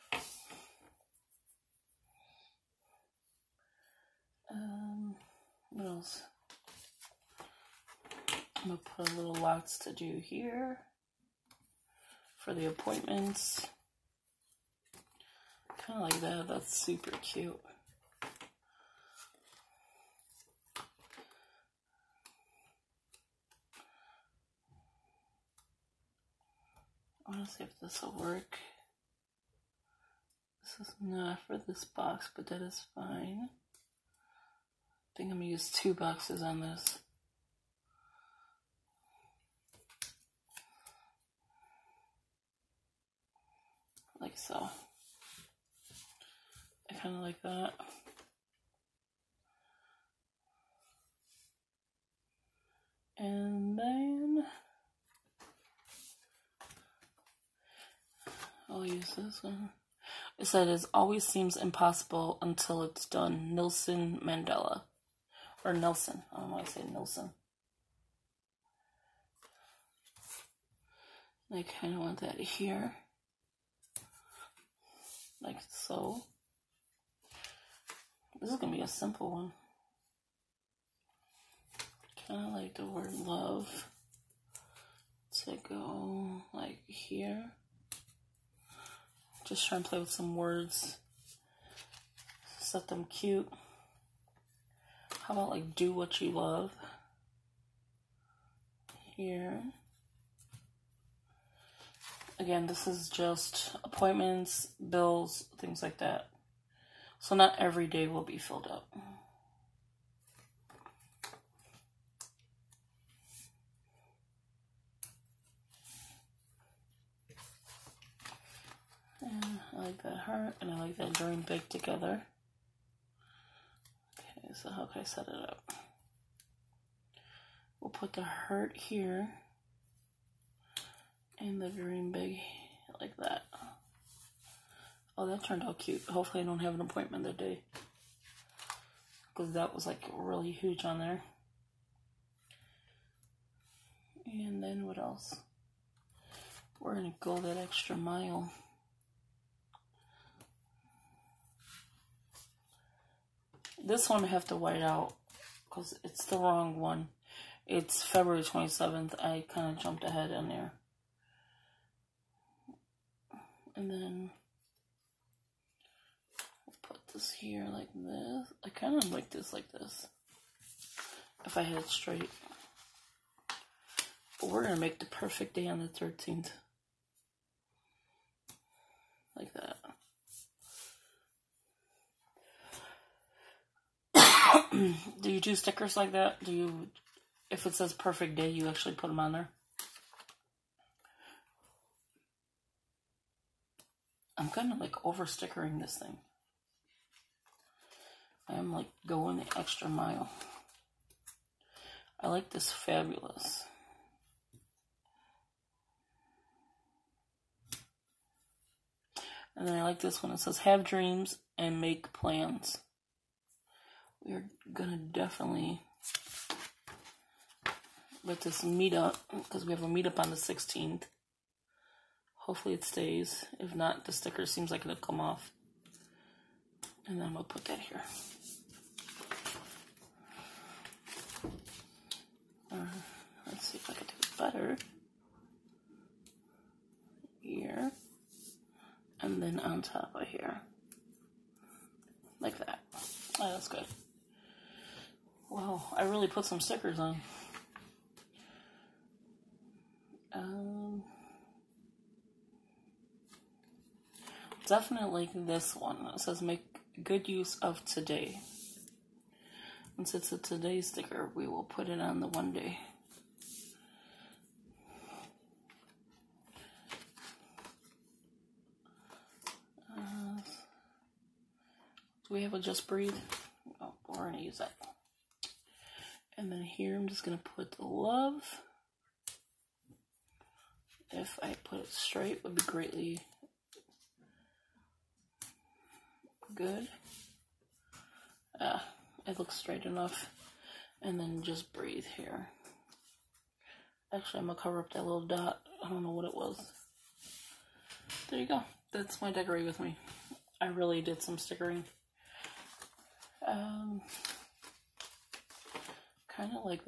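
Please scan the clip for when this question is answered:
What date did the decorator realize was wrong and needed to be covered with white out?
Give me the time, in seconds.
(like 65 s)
158 s.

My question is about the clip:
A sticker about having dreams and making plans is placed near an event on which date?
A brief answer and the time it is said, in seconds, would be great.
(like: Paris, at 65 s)
16th, at 220 s.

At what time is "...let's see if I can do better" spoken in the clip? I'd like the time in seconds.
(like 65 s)
233 s.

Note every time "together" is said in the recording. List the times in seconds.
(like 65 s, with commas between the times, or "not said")
121 s.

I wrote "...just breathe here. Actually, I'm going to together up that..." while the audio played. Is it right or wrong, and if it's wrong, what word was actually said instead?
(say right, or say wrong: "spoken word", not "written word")
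wrong: "cover", not "together".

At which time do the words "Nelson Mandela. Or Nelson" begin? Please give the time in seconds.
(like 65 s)
63 s.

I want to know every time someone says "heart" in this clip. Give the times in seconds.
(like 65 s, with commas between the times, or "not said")
120 s, 128 s.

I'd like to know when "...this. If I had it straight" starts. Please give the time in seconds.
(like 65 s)
169 s.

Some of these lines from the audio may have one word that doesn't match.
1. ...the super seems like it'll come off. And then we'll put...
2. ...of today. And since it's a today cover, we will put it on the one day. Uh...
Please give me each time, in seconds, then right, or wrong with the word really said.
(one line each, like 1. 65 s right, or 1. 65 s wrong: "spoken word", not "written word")
1. 224 s wrong: "sticker", not "super"
2. 257 s wrong: "sticker", not "cover".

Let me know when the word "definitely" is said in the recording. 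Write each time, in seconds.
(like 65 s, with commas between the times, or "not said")
214 s, 254 s.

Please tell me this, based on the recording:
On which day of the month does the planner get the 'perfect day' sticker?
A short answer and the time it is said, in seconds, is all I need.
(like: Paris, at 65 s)
13th, at 175 s.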